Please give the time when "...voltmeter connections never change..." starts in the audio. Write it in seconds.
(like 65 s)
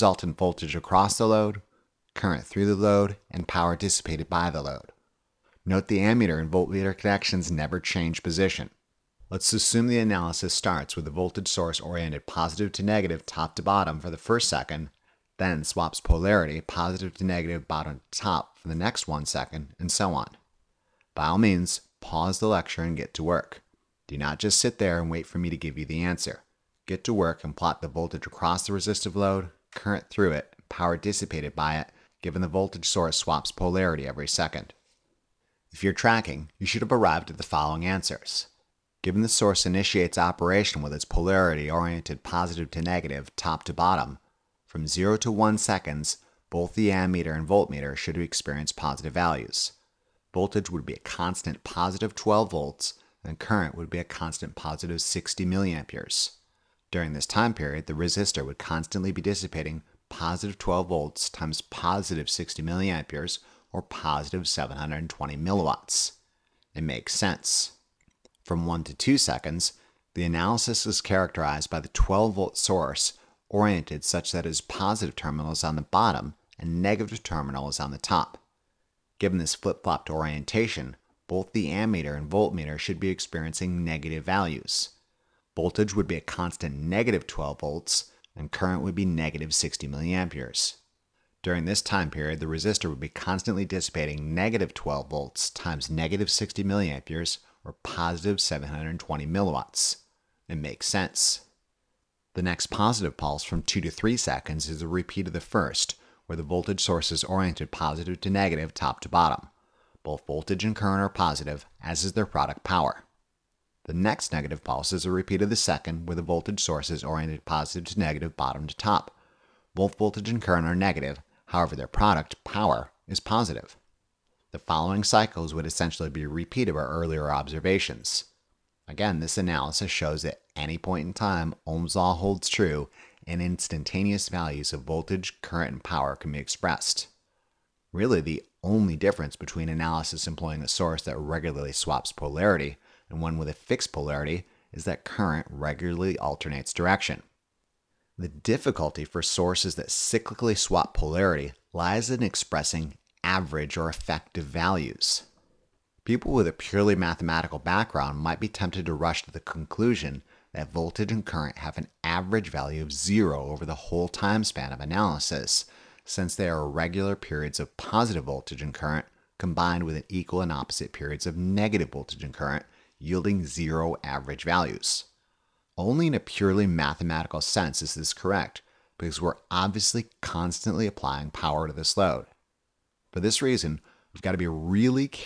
6 s.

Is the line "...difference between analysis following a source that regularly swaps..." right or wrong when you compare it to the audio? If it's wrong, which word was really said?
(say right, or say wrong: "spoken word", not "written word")
wrong: "employing", not "following".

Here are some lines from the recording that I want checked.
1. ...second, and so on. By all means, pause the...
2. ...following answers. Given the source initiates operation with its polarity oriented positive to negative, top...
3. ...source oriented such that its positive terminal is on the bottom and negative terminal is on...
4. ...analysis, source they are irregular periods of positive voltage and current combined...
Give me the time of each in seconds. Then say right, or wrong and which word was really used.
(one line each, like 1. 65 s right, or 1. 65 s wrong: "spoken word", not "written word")
1. 19 s right
2. 37 s right
3. 72 s right
4. 164 s wrong: "since", not "source".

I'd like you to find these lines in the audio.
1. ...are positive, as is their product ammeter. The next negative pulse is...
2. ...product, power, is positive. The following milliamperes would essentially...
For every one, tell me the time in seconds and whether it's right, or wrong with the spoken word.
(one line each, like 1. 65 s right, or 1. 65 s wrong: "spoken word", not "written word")
1. 111 s wrong: "power", not "ammeter"
2. 121 s wrong: "cycles", not "milliamperes".